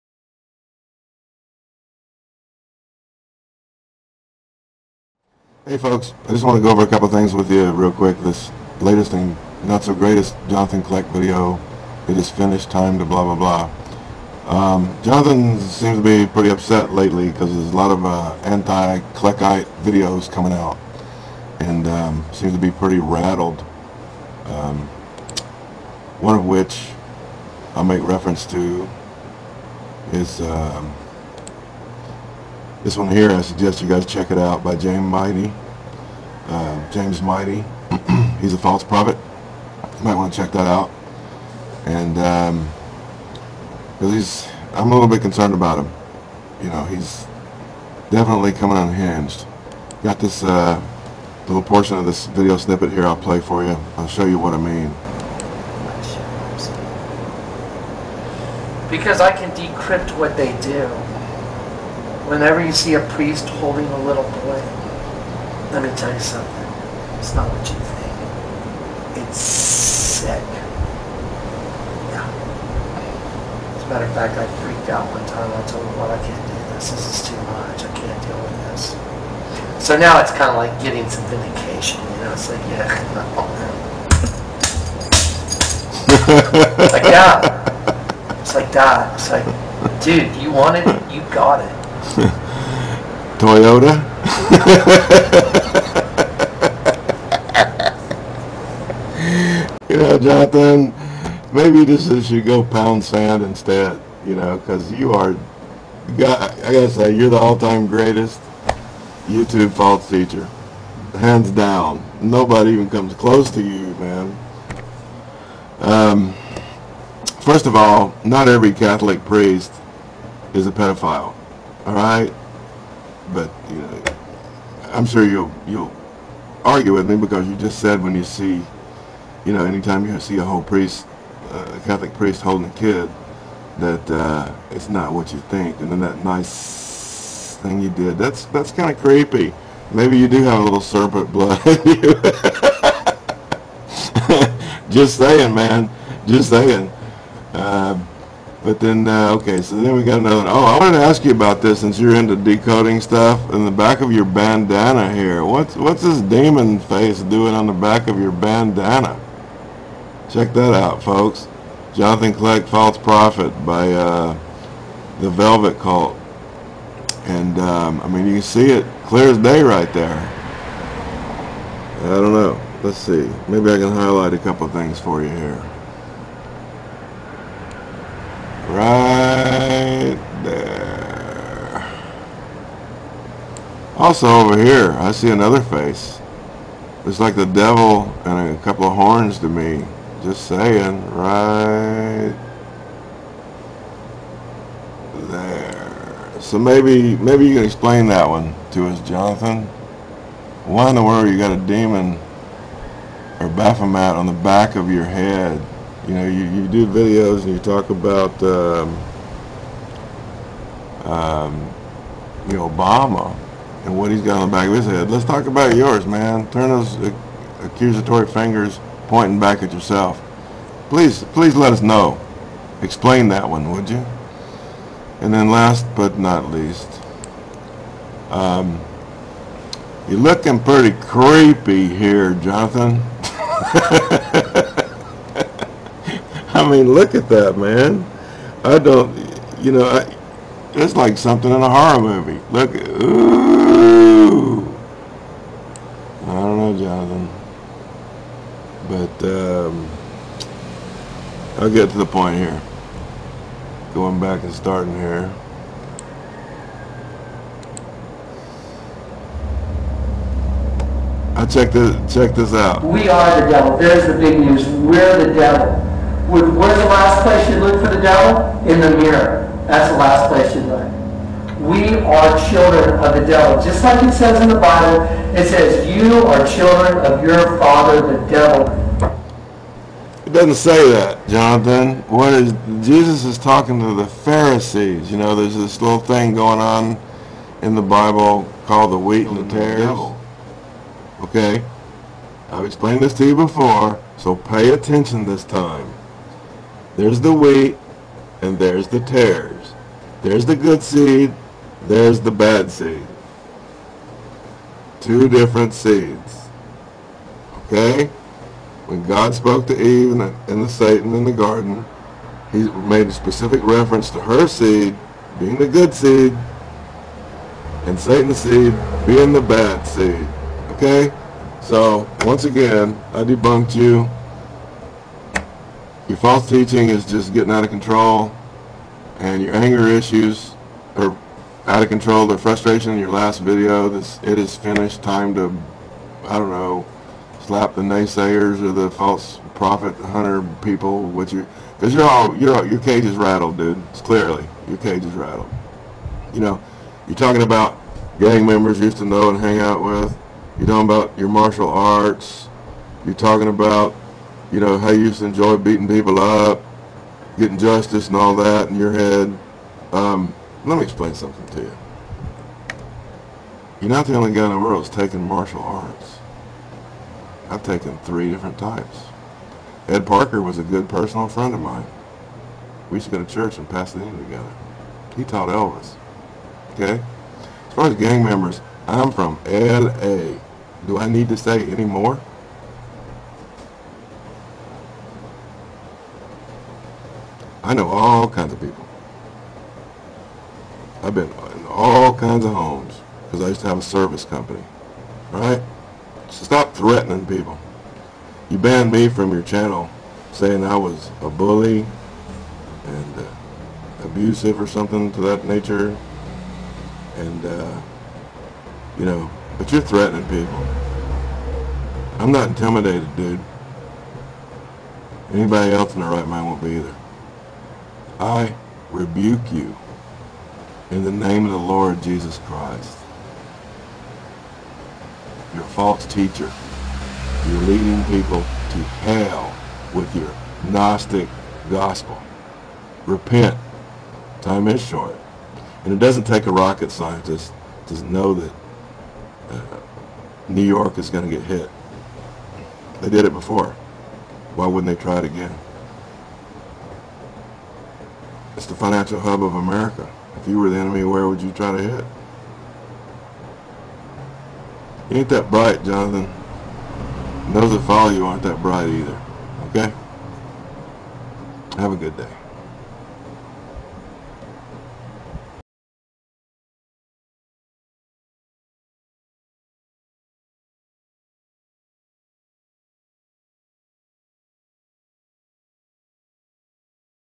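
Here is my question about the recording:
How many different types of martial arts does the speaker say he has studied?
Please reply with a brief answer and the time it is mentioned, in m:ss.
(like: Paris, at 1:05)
3, at 6:07.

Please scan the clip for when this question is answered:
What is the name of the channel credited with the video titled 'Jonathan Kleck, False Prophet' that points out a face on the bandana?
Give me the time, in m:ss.
2:45.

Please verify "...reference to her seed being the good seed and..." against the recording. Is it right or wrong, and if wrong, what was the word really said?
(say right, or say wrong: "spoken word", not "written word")
right.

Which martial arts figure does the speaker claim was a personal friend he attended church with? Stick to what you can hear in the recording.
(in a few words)
Ed Parker.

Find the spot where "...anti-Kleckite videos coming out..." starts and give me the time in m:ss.
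0:18.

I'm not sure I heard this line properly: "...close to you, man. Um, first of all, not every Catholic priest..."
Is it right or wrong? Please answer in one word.
right.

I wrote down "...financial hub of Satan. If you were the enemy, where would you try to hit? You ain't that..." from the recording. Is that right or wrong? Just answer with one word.
wrong.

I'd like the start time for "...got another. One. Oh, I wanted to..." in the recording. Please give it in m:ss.
2:30.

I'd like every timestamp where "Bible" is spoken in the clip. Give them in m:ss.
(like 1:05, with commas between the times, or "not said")
4:34, 4:47.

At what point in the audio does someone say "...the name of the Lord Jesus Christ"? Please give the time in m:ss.
7:01.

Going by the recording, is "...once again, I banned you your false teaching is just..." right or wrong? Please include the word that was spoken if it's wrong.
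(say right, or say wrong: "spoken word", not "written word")
wrong: "debunked", not "banned".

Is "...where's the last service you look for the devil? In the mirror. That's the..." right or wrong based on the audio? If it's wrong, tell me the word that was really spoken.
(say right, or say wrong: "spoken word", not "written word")
wrong: "place", not "service".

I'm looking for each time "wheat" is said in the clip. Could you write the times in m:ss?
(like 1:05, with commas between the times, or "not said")
4:48, 4:57.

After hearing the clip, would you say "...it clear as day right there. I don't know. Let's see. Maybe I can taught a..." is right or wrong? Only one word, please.
wrong.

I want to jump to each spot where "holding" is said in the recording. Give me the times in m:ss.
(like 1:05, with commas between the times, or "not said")
1:03, 2:12.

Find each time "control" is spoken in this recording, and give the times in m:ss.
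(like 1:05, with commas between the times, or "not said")
5:27, 5:31.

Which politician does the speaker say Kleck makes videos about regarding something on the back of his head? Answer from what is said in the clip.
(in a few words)
Obama.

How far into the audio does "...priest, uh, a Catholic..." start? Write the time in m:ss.
2:10.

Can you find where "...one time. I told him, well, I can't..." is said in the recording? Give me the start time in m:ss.
1:15.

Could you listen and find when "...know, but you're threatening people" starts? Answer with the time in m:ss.
6:49.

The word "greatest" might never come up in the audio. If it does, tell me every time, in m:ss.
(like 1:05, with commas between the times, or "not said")
0:09, 1:47.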